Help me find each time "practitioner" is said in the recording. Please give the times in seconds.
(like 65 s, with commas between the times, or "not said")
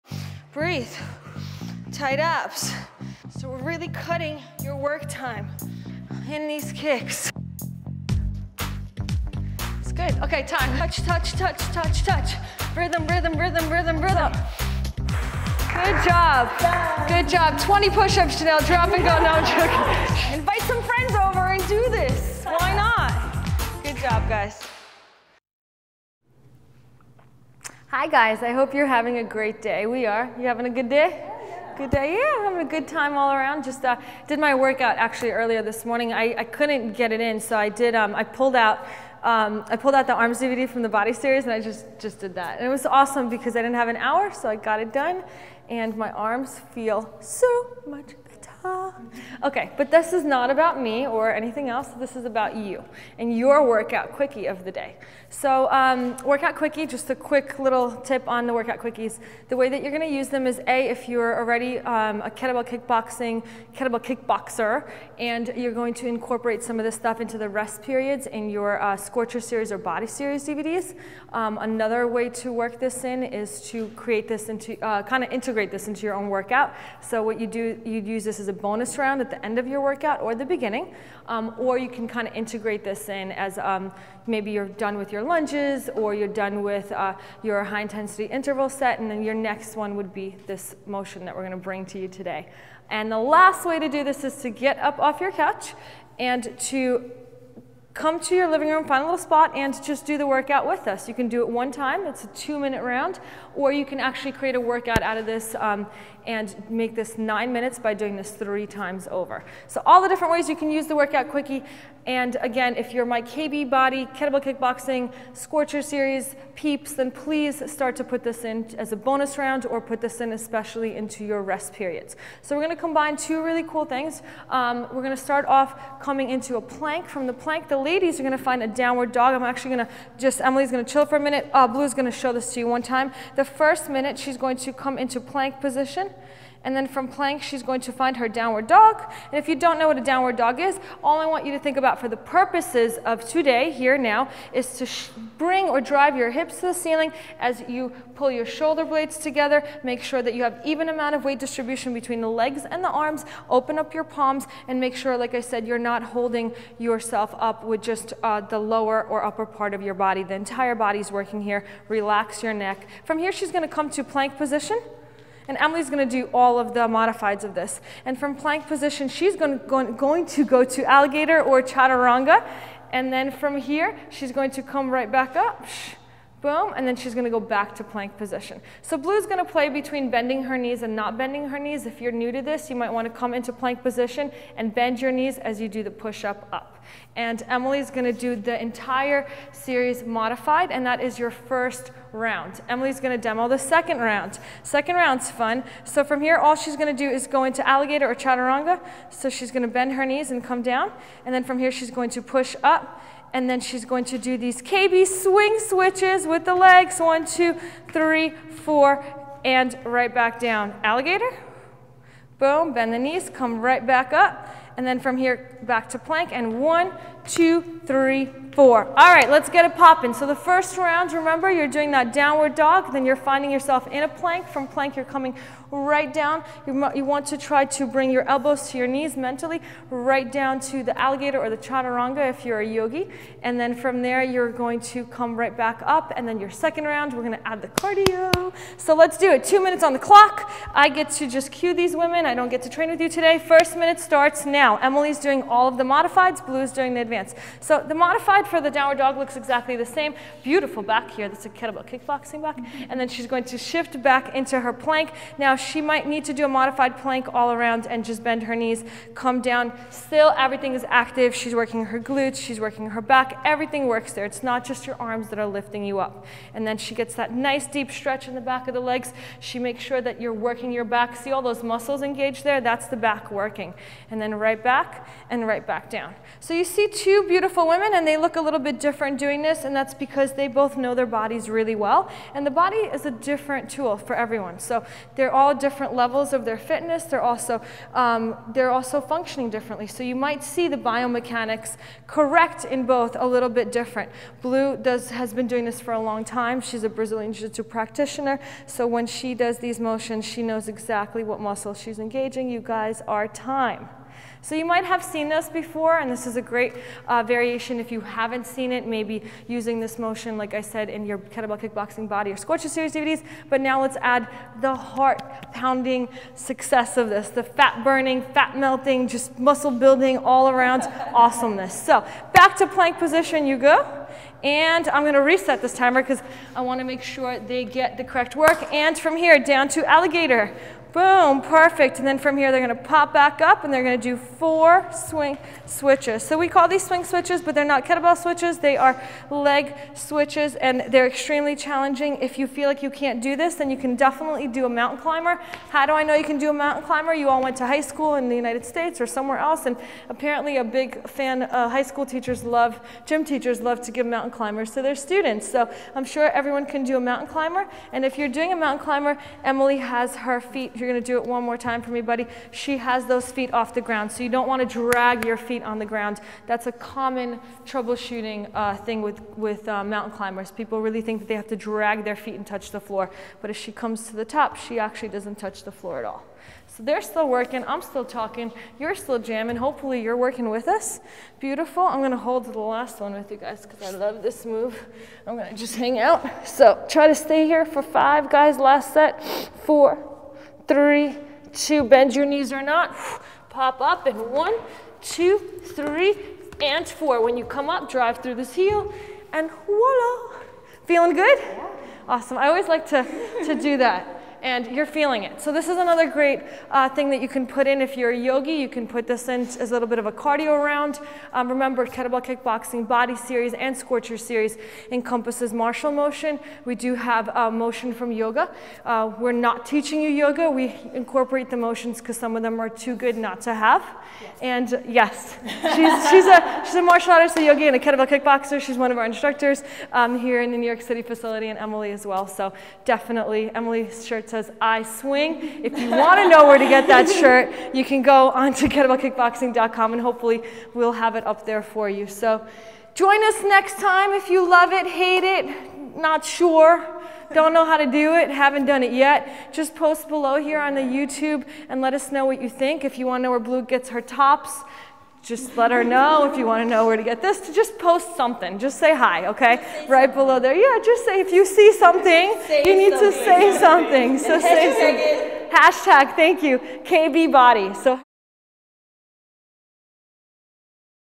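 297 s.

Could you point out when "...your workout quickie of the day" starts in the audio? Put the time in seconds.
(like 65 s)
53 s.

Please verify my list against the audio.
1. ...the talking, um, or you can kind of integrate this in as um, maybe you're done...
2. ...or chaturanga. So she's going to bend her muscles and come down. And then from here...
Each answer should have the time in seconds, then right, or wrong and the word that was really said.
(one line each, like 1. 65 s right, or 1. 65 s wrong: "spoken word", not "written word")
1. 80 s wrong: "beginning", not "talking"
2. 198 s wrong: "knees", not "muscles".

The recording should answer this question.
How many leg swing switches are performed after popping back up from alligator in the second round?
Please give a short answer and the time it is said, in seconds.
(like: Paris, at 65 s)
4, at 334 s.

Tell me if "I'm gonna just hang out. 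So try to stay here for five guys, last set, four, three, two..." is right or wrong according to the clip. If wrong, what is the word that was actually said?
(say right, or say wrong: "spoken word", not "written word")
right.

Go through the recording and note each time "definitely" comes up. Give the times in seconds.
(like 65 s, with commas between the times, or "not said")
343 s, 432 s.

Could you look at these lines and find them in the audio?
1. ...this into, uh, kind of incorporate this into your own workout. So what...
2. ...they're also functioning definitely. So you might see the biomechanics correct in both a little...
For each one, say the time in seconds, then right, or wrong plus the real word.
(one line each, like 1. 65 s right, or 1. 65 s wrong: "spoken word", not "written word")
1. 74 s wrong: "integrate", not "incorporate"
2. 288 s wrong: "differently", not "definitely".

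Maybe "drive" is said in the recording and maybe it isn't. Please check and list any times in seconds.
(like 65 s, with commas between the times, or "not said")
145 s, 397 s.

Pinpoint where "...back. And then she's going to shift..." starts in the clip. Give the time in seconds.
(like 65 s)
252 s.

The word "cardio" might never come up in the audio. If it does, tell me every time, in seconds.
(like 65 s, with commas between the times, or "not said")
237 s, 410 s.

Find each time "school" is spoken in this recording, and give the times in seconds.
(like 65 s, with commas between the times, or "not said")
347 s, 351 s.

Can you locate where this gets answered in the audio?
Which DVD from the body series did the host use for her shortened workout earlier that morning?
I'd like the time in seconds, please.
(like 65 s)
40 s.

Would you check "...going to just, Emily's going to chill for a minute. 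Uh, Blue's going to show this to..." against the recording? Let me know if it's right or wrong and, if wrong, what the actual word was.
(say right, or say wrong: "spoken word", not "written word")
right.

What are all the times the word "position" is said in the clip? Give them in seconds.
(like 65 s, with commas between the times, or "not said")
135 s, 164 s, 168 s, 178 s, 183 s, 322 s.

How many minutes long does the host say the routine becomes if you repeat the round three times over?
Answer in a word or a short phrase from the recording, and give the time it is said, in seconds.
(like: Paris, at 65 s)
9, at 107 s.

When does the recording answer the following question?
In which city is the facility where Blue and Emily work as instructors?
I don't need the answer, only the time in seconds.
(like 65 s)
430 s.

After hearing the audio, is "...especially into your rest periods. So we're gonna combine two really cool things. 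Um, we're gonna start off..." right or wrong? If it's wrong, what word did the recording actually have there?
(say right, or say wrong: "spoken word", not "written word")
right.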